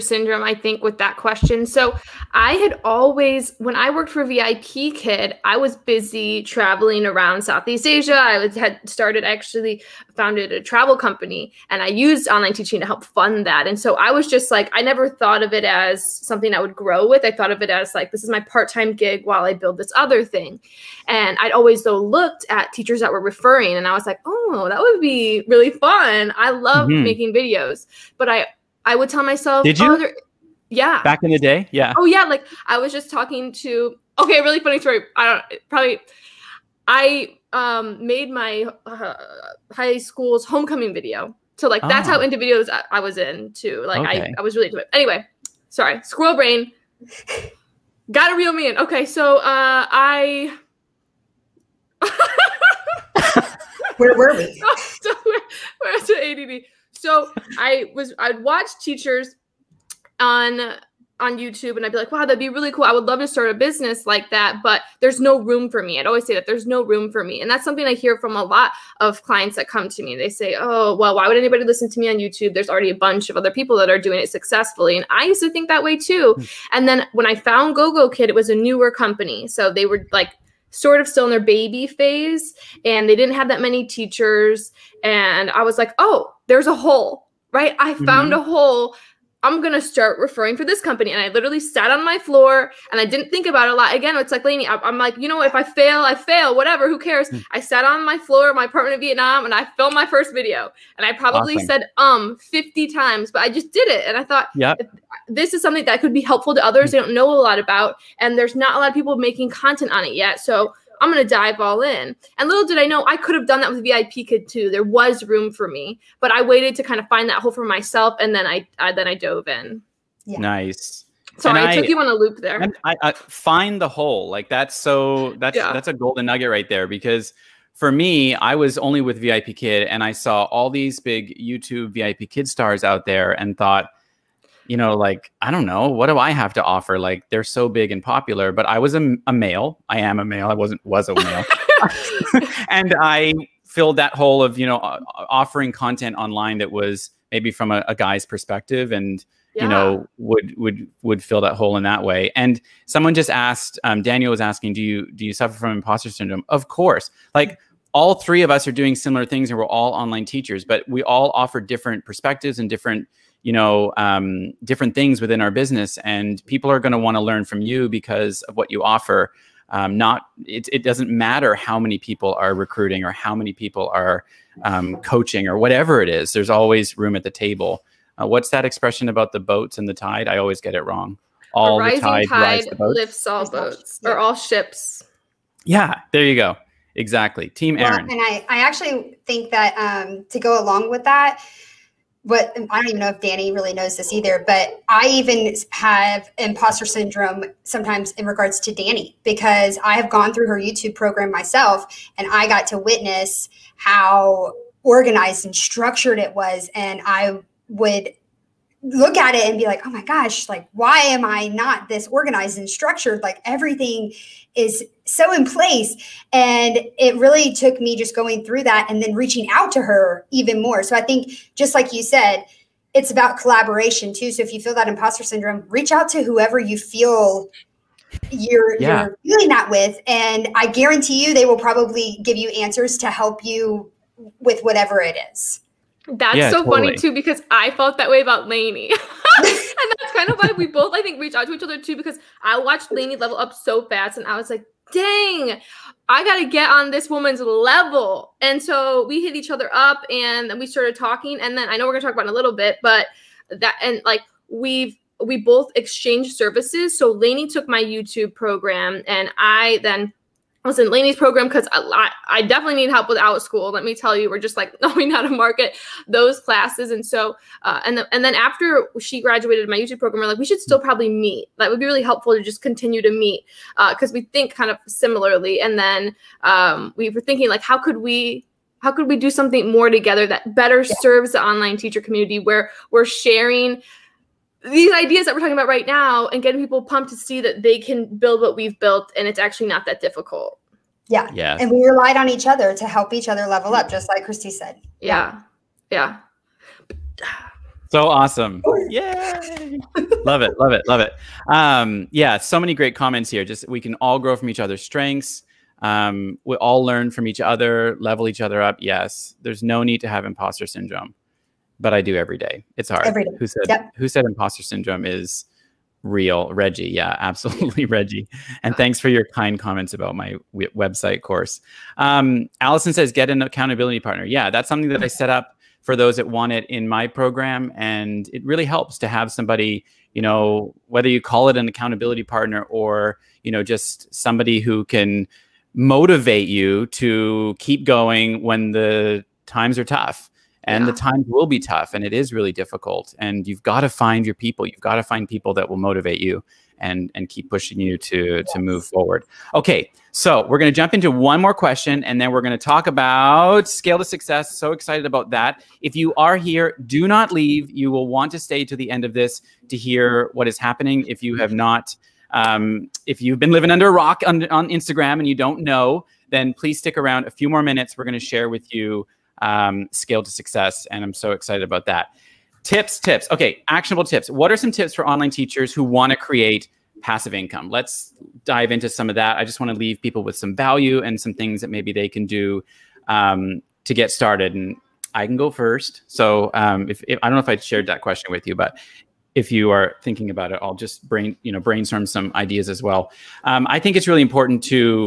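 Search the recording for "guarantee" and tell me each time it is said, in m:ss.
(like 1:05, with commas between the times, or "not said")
3:50.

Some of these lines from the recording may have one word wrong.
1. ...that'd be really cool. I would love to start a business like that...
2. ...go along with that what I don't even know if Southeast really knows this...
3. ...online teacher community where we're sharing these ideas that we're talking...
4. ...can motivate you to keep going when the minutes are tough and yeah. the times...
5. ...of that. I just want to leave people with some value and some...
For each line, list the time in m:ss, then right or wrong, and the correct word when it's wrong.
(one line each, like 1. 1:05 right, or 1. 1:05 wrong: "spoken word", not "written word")
1. 1:02 right
2. 3:10 wrong: "Danie", not "Southeast"
3. 4:41 right
4. 5:34 wrong: "times", not "minutes"
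5. 6:19 right.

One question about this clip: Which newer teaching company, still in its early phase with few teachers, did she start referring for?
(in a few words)
GoGo Kid.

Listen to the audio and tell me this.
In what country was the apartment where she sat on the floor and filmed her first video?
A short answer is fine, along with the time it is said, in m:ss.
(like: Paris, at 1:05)
Vietnam, at 1:38.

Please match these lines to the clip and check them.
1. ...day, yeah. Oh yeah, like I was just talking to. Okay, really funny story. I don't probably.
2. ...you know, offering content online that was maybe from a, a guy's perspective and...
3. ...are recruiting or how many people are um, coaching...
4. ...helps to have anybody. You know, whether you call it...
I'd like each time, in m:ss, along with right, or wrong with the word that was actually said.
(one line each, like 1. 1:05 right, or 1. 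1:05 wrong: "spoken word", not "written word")
1. 0:31 right
2. 2:24 right
3. 2:52 right
4. 5:28 wrong: "somebody", not "anybody".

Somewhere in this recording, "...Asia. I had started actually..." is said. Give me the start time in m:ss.
0:07.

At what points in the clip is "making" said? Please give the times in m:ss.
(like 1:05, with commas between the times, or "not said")
0:27, 1:49.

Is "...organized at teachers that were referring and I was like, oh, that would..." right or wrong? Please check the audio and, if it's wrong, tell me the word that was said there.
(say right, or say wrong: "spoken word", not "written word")
wrong: "looked", not "organized".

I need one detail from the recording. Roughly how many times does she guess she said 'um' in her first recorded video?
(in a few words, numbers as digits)
50.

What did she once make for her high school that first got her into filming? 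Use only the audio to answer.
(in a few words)
homecoming video.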